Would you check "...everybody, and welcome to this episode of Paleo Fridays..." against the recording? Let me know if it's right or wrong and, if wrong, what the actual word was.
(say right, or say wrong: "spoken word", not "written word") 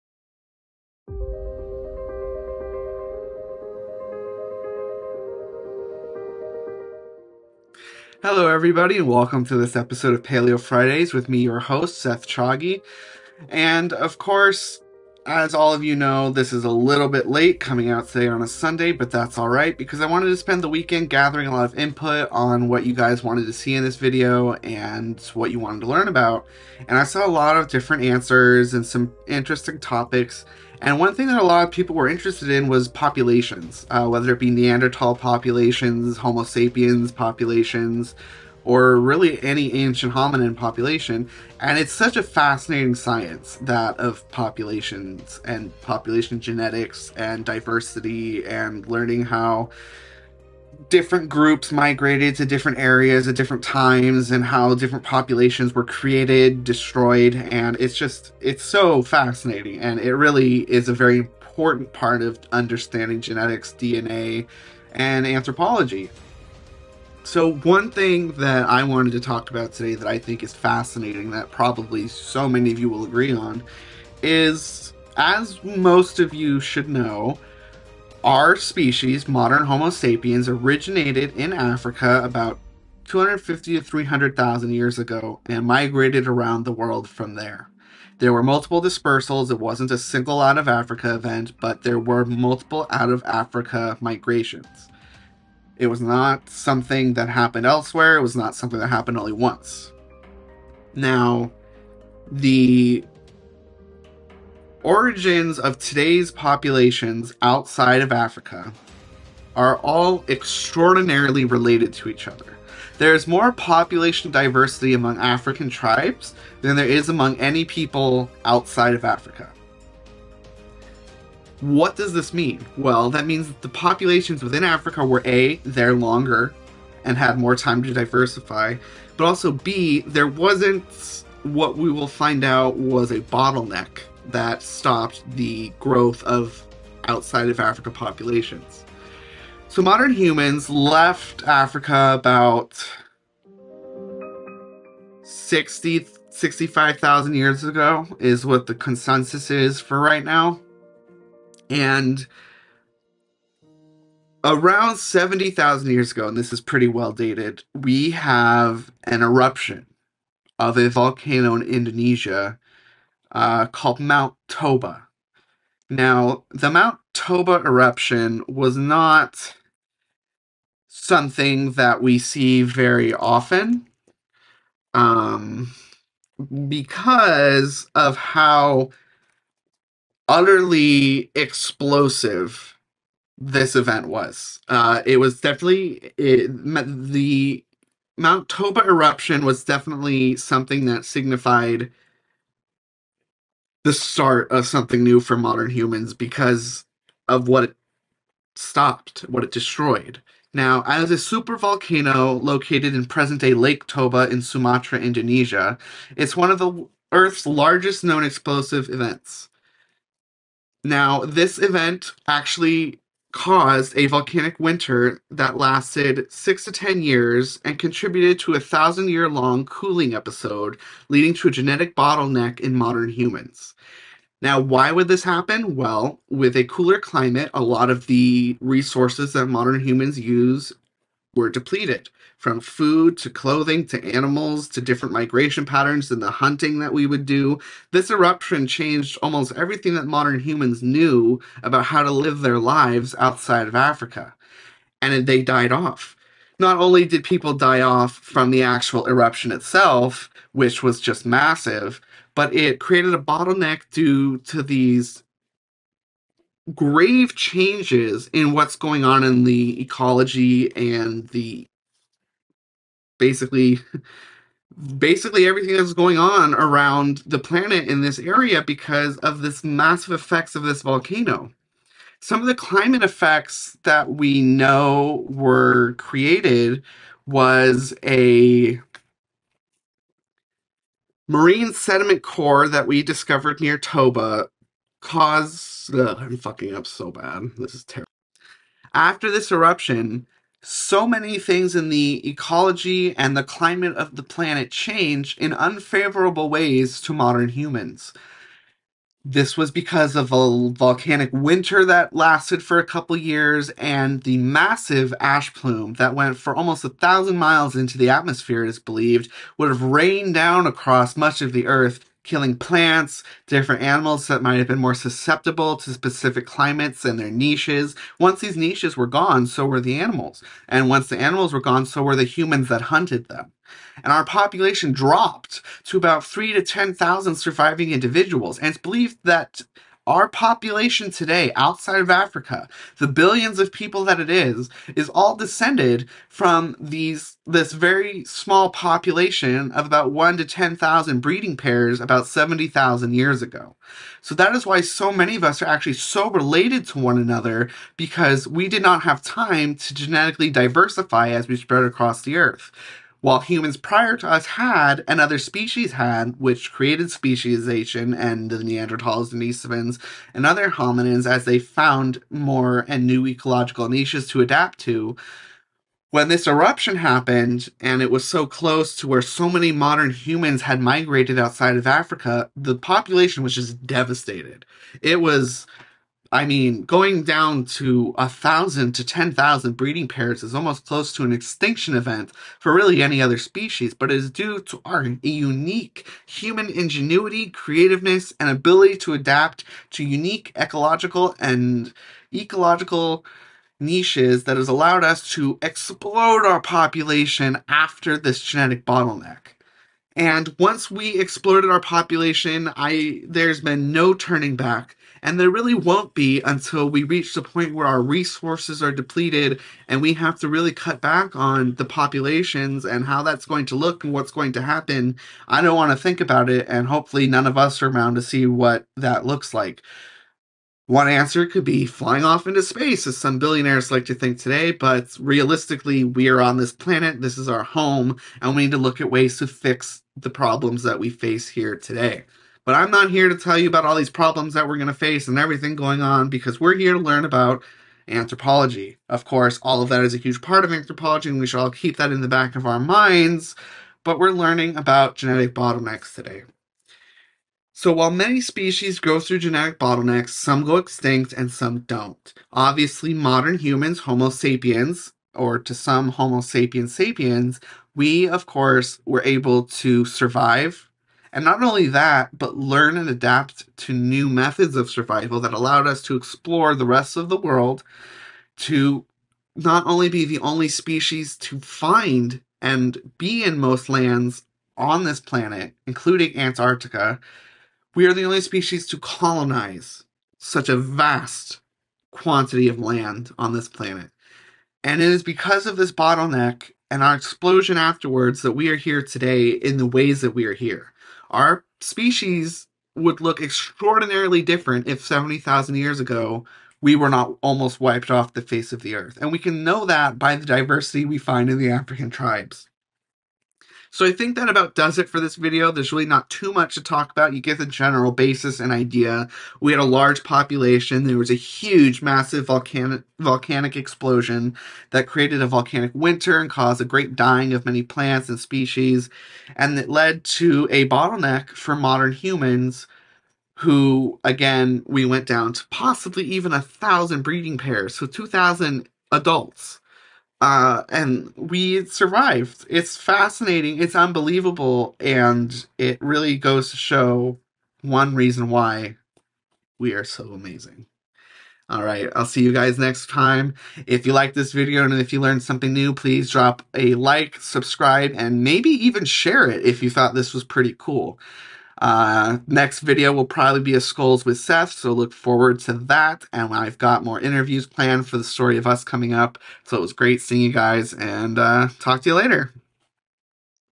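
right.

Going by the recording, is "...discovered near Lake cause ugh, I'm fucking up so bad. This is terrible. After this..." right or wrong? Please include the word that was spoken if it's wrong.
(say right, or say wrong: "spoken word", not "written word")
wrong: "Toba", not "Lake".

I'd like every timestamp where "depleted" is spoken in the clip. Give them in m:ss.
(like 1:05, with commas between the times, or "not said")
3:51, 6:48.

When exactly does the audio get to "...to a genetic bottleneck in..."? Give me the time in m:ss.
3:41.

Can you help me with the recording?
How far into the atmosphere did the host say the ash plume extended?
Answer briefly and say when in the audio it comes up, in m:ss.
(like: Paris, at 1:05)
almost 1,000 miles, at 5:06.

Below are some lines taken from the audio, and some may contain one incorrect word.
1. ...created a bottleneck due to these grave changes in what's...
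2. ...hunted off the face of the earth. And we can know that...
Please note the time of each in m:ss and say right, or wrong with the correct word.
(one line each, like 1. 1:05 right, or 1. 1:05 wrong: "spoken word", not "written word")
1. 4:12 right
2. 8:17 wrong: "wiped", not "hunted".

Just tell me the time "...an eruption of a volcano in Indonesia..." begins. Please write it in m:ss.
2:39.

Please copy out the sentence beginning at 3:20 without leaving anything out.
Now, as a supervolcano located in present day Lake Toba in Sumatra, Indonesia, it's one of the Earth's largest known explosive events.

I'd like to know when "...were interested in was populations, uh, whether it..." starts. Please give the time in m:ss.
0:31.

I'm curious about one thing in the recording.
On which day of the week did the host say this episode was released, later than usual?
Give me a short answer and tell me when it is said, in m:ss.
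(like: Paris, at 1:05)
Sunday, at 0:18.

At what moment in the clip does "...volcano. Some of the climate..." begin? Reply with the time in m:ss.
4:30.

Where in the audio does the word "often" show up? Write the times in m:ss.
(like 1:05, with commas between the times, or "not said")
2:53.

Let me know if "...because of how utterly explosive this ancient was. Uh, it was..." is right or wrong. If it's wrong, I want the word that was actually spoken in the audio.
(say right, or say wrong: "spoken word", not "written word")
wrong: "event", not "ancient".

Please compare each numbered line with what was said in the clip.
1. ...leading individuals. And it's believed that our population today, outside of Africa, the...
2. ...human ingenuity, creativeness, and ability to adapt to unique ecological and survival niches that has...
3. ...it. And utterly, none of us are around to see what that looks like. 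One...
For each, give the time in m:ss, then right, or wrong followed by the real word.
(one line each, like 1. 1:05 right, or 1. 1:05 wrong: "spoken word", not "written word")
1. 5:27 wrong: "surviving", not "leading"
2. 6:26 wrong: "ecological", not "survival"
3. 6:56 wrong: "hopefully", not "utterly".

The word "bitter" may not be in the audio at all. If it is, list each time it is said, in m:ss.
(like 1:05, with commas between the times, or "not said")
not said.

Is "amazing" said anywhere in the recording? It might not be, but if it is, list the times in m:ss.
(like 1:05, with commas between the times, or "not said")
9:00.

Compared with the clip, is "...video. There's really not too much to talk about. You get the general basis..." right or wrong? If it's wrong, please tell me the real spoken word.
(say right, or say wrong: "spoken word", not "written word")
right.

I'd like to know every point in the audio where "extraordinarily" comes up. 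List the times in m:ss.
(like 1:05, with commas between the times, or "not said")
1:50, 8:13.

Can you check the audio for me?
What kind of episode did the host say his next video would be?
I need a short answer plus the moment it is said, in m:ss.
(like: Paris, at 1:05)
Skulls with Seth, at 9:13.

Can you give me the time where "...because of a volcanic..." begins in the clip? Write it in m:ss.
4:59.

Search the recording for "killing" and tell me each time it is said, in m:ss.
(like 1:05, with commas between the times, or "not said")
5:12.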